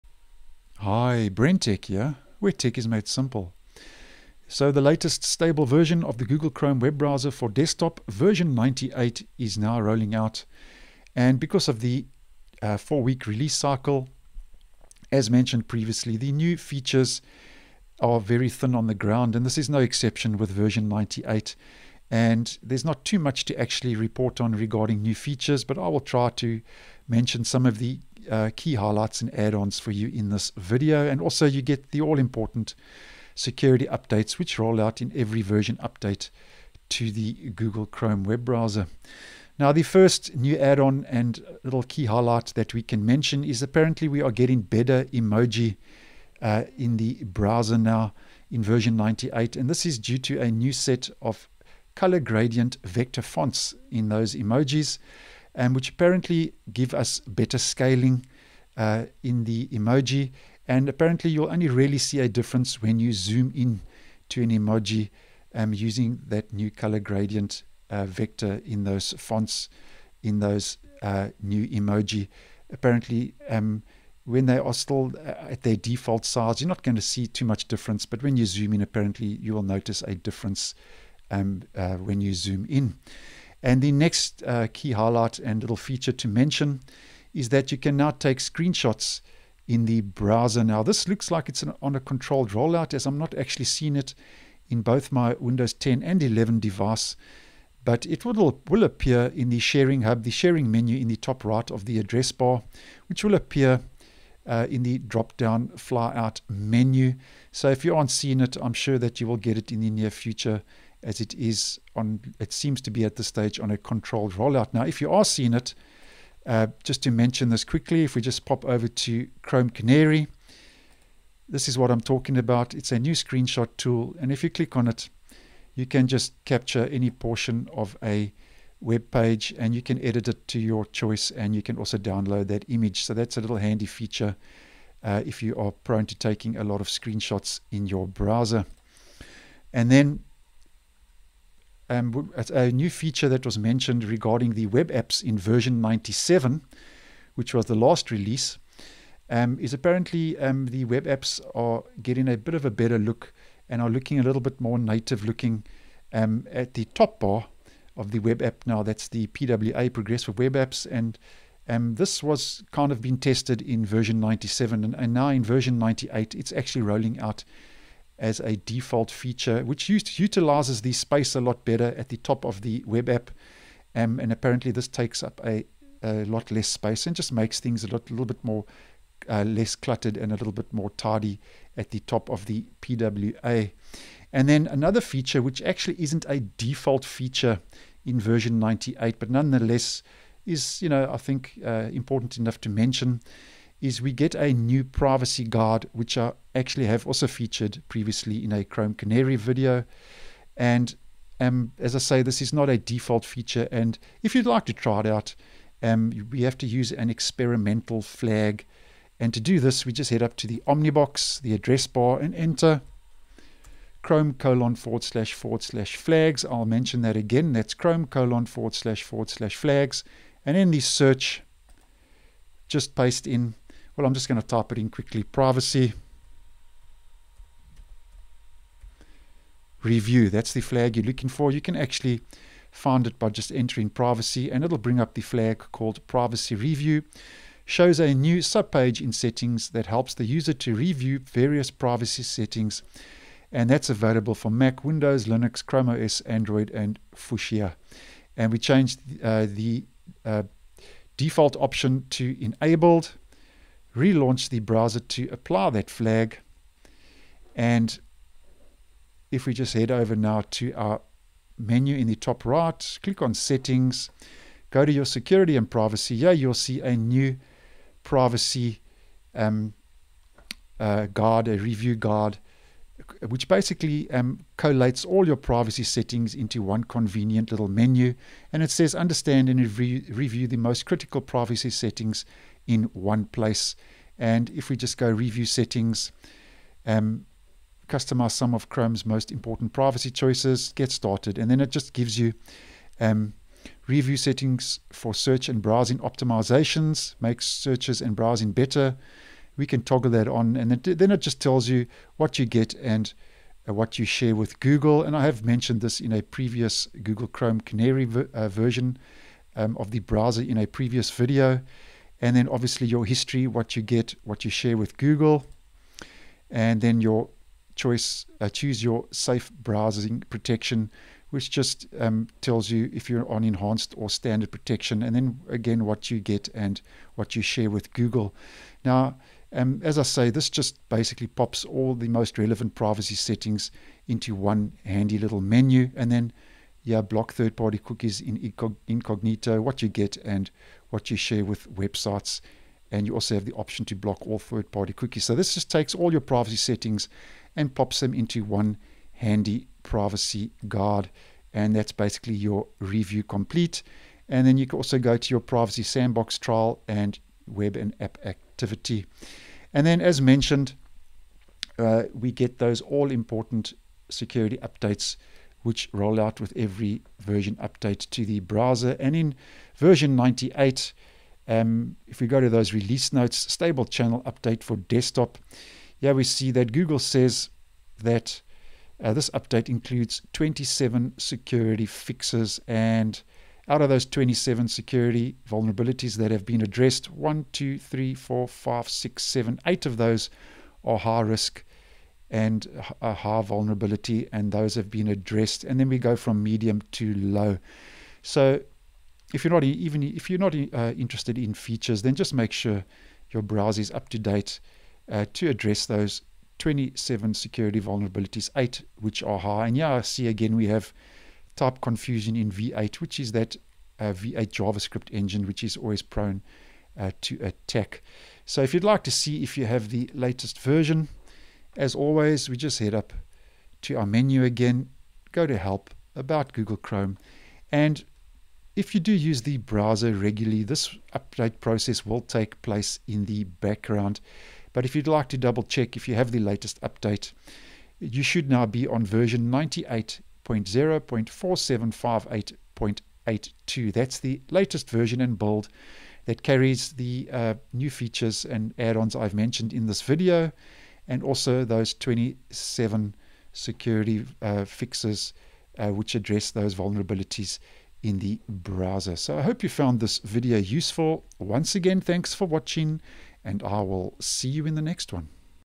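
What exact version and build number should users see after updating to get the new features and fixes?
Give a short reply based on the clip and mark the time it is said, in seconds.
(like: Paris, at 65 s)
98.0.4758.82, at 439 s.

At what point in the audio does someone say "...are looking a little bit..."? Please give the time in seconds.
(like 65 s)
153 s.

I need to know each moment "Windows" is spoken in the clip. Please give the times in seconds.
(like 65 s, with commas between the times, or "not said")
95 s, 244 s.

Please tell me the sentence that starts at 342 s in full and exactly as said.
And you also have the option to block all third party cookies.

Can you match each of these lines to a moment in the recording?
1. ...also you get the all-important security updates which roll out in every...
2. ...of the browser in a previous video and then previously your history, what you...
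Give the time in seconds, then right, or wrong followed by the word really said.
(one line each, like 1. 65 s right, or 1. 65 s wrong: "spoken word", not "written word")
1. 31 s right
2. 309 s wrong: "obviously", not "previously".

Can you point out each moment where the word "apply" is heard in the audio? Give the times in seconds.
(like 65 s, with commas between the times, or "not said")
255 s.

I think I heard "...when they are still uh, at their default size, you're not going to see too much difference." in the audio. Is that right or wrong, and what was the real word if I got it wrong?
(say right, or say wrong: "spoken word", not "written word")
right.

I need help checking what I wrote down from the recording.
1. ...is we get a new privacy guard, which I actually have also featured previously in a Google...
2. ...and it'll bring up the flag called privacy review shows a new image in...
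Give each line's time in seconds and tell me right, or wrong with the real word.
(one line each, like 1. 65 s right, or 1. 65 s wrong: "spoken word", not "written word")
1. 193 s wrong: "Chrome", not "Google"
2. 234 s wrong: "subpage", not "image".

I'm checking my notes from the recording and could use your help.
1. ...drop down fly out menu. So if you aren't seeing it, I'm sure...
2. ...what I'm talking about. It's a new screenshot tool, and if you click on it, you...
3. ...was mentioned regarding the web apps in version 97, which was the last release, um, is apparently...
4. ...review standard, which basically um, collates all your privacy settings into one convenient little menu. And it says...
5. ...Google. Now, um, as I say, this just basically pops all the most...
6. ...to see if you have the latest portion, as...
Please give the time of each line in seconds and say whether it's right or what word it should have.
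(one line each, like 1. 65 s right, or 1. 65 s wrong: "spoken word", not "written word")
1. 104 s right
2. 121 s right
3. 143 s right
4. 271 s wrong: "guard", not "standard"
5. 327 s right
6. 419 s wrong: "version", not "portion".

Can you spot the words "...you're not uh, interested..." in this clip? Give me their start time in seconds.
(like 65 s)
400 s.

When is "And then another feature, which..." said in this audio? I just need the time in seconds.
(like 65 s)
184 s.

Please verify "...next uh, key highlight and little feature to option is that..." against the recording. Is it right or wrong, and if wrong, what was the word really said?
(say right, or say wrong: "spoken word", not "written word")
wrong: "mention", not "option".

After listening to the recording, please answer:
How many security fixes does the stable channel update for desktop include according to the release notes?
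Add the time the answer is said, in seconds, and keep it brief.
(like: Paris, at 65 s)
27, at 380 s.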